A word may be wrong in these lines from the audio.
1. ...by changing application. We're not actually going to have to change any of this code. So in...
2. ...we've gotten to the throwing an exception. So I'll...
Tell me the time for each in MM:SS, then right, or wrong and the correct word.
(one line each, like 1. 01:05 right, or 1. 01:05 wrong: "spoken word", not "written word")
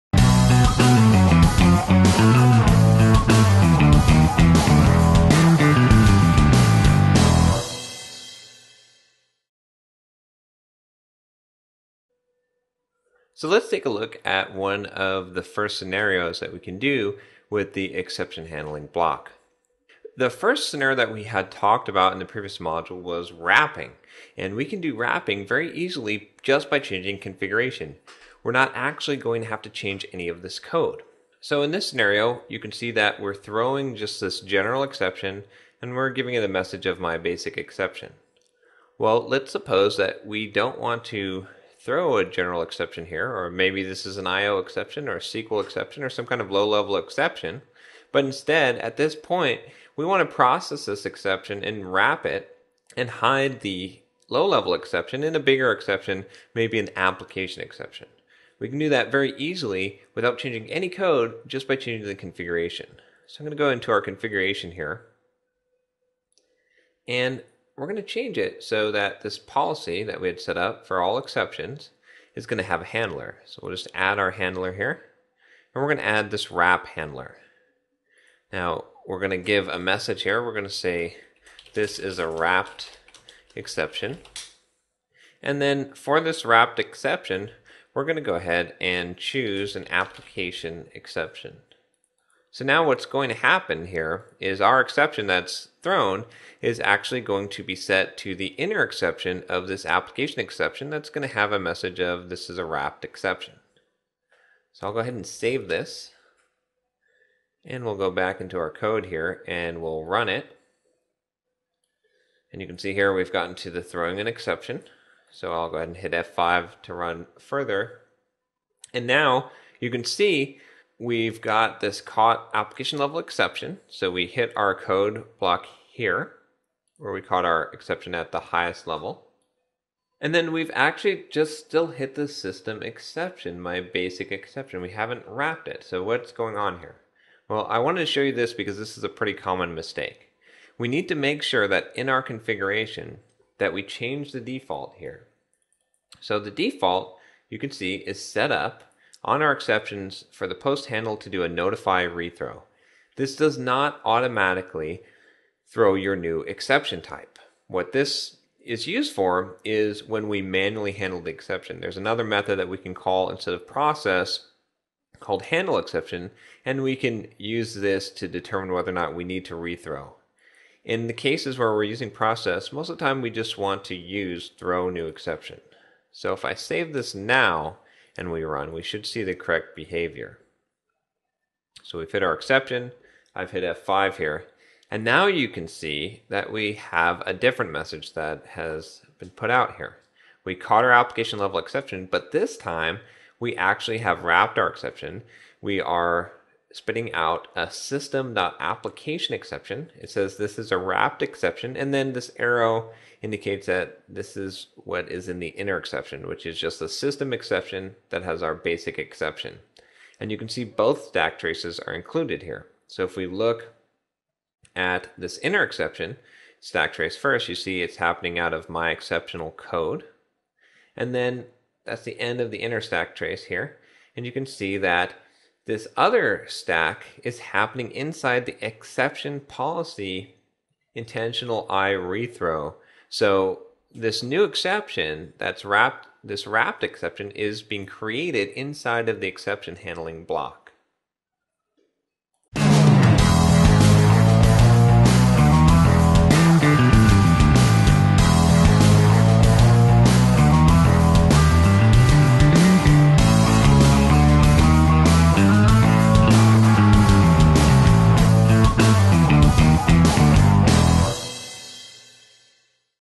1. 00:26 wrong: "configuration", not "application"
2. 01:53 right.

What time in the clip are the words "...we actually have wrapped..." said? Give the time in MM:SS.
03:13.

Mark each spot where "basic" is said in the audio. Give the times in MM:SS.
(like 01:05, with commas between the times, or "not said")
00:37, 02:13, 03:28.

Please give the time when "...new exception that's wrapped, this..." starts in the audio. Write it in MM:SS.
03:54.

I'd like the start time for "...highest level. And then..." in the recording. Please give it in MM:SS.
02:08.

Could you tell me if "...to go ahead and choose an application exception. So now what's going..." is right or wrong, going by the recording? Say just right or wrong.
right.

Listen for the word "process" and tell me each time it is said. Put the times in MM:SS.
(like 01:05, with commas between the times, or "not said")
00:50, 02:43, 02:52.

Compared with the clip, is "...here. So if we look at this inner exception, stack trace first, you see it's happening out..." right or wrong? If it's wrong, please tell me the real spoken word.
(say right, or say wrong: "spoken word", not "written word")
right.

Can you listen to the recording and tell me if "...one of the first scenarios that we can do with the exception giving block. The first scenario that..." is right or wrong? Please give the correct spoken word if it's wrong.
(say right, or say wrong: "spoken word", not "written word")
wrong: "handling", not "giving".